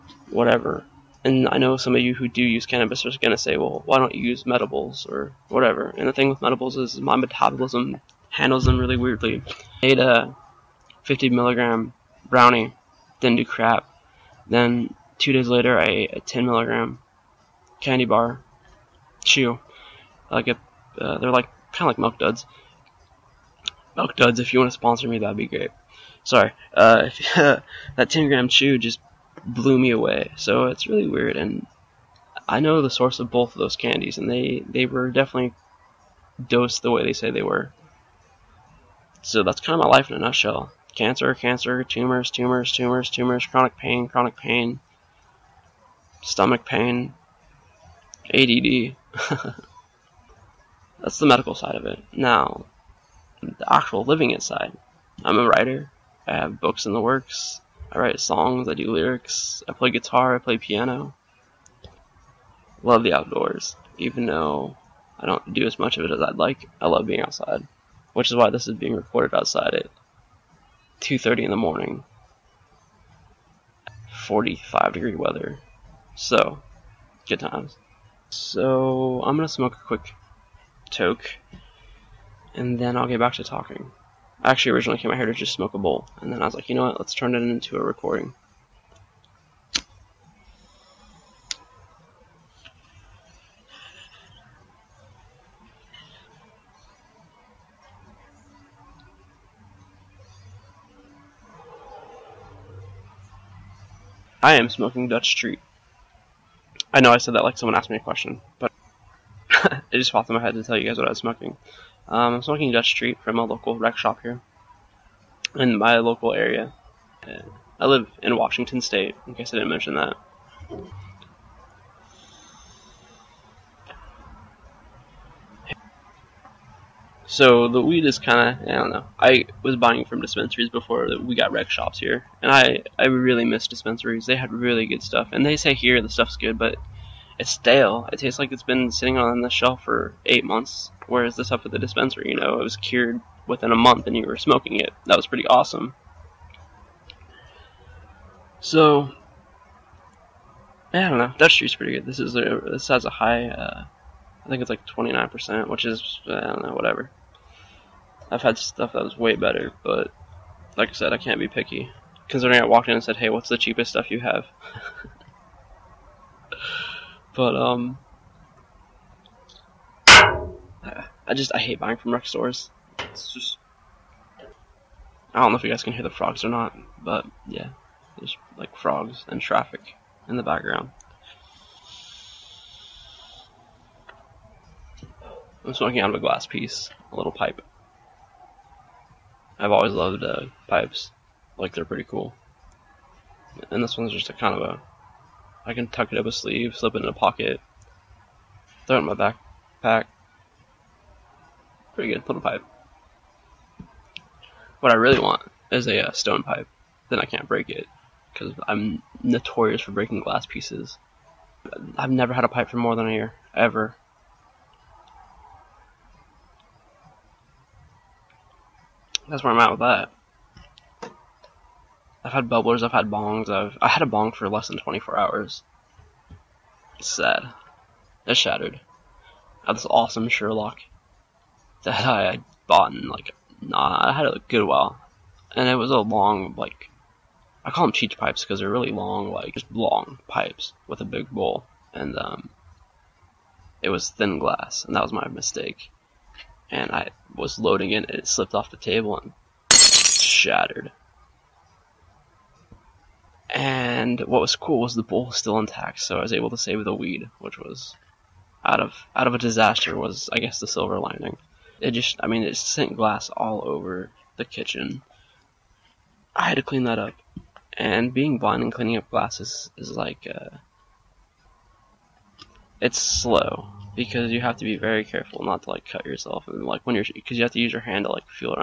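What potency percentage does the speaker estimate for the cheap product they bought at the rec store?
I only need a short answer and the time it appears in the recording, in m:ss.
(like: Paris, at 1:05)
29%, at 2:34.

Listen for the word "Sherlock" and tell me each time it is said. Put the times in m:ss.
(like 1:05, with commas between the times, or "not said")
3:50.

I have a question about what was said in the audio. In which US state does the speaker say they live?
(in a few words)
Washington State.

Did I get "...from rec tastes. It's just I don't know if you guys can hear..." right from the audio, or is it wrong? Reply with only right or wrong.
wrong.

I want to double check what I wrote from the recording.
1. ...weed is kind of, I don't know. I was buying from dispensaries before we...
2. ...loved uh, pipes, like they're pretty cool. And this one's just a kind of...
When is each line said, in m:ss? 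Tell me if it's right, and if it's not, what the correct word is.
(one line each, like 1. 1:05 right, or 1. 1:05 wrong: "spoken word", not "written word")
1. 2:07 right
2. 3:09 right.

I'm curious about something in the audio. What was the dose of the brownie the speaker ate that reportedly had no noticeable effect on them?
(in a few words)
50 milligrams.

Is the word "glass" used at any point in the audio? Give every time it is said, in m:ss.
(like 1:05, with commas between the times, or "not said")
3:06, 3:30, 4:04, 4:22, 4:29.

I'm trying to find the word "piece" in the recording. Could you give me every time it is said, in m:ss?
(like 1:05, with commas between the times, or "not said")
3:06, 3:30.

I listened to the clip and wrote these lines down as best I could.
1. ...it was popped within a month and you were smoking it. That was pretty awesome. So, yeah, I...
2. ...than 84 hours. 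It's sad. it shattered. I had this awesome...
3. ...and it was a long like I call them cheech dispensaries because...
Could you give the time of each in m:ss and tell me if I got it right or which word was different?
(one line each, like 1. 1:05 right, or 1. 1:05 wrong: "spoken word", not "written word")
1. 2:22 wrong: "cured", not "popped"
2. 3:44 wrong: "24", not "84"
3. 3:55 wrong: "pipes", not "dispensaries".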